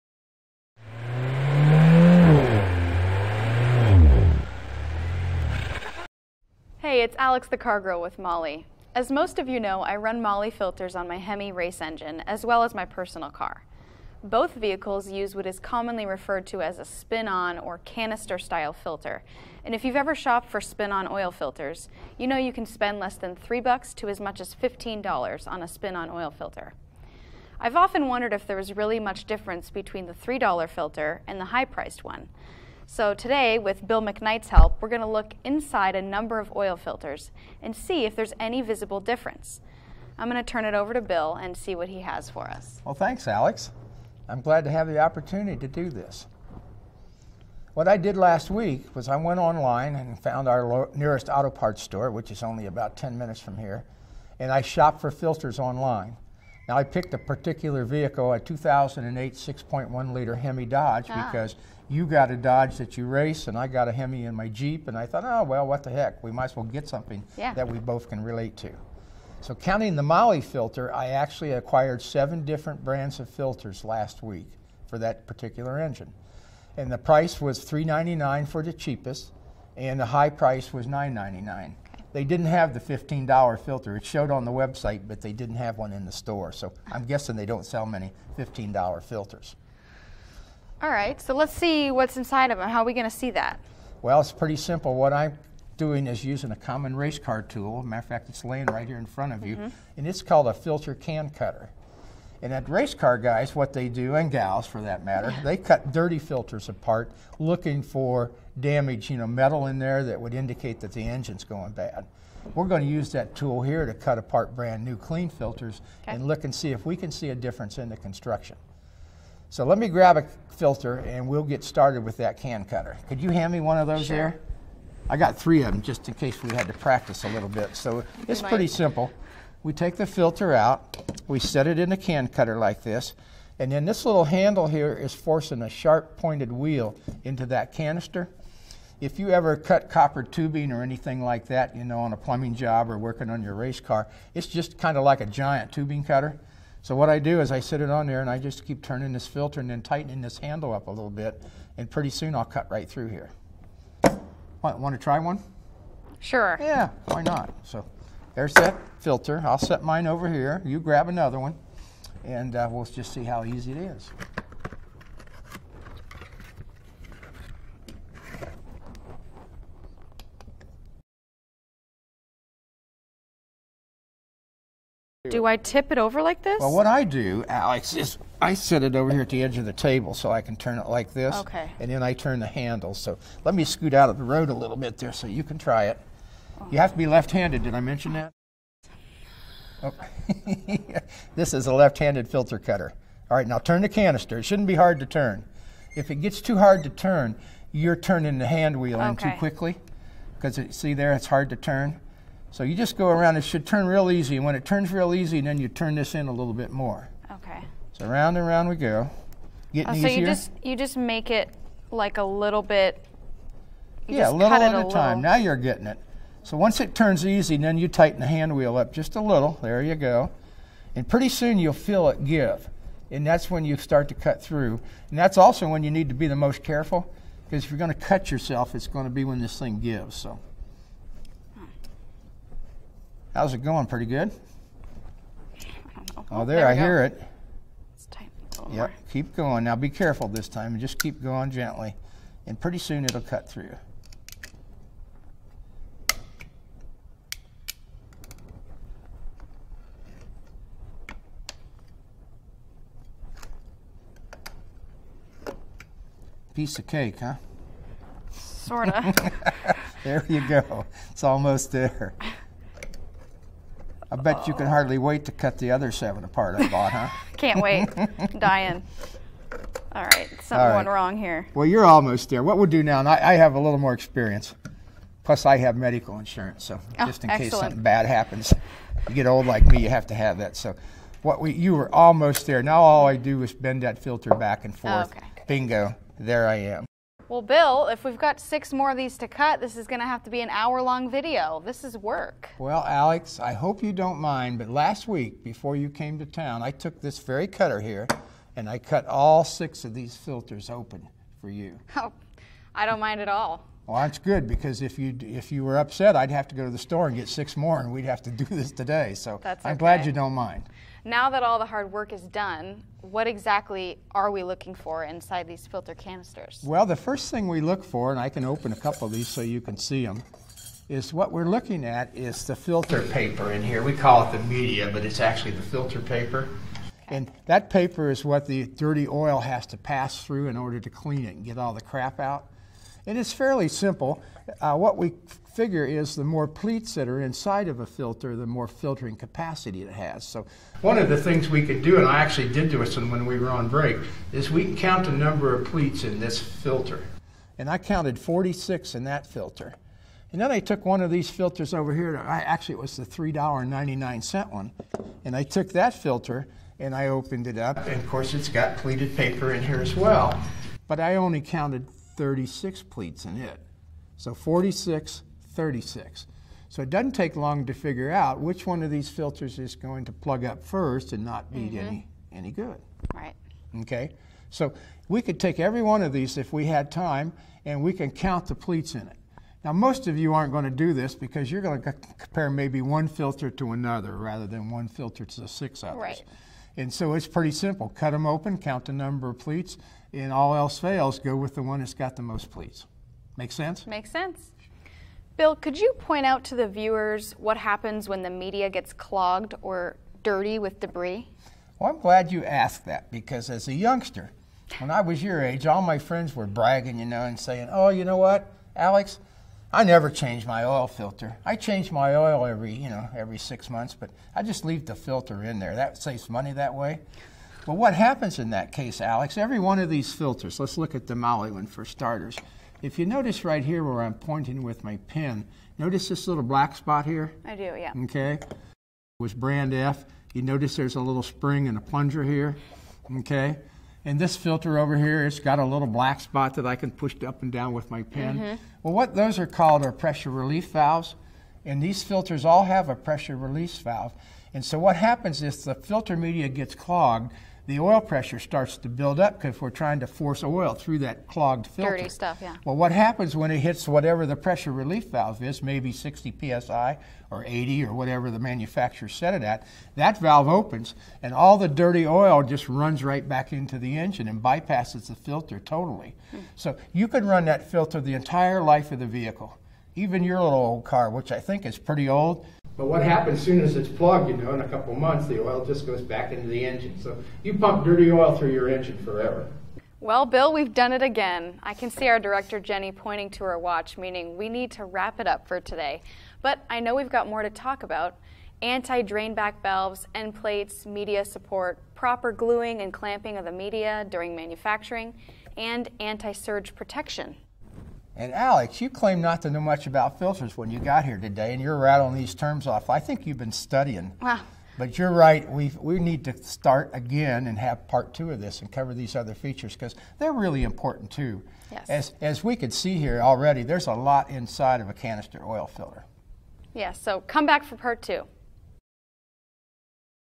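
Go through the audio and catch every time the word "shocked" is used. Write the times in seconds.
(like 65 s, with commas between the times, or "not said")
not said.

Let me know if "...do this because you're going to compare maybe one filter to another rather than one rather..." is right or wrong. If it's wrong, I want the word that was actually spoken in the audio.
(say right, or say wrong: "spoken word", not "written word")
wrong: "filter", not "rather".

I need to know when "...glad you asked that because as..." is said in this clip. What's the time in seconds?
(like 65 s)
401 s.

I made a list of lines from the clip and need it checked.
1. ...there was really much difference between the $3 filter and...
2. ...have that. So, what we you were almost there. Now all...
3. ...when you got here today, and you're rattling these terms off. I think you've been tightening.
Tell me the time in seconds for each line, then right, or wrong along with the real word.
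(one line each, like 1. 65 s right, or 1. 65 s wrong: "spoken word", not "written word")
1. 28 s right
2. 280 s right
3. 500 s wrong: "studying", not "tightening".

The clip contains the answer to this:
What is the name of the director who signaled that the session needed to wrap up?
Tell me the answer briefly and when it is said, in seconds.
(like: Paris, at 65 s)
Jenny, at 482 s.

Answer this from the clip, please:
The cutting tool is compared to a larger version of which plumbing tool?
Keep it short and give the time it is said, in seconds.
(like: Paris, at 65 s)
tubing cutter, at 145 s.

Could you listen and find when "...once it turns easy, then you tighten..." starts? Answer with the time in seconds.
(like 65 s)
216 s.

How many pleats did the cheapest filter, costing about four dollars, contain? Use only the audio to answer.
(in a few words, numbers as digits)
36.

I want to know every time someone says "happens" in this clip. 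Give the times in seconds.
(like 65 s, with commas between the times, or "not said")
278 s, 397 s, 417 s, 444 s, 452 s, 473 s.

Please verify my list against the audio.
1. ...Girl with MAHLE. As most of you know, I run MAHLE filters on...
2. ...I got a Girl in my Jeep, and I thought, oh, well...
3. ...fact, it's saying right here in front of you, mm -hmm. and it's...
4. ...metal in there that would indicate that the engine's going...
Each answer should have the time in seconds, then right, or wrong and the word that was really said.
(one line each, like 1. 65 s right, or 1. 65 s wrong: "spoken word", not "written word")
1. 7 s right
2. 63 s wrong: "Hemi", not "Girl"
3. 98 s wrong: "laying", not "saying"
4. 109 s right.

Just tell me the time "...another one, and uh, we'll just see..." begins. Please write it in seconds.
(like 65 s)
161 s.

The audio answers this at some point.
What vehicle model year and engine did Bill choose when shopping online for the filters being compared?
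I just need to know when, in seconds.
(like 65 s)
58 s.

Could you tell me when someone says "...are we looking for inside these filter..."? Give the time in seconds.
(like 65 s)
314 s.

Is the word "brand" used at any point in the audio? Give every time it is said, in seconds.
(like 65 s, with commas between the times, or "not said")
72 s, 114 s, 429 s.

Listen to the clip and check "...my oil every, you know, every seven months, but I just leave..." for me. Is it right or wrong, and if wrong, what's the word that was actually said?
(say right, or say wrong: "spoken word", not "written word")
wrong: "six", not "seven".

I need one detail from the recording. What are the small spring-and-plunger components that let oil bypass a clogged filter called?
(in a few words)
pressure relief valves.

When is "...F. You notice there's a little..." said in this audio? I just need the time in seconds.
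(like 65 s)
429 s.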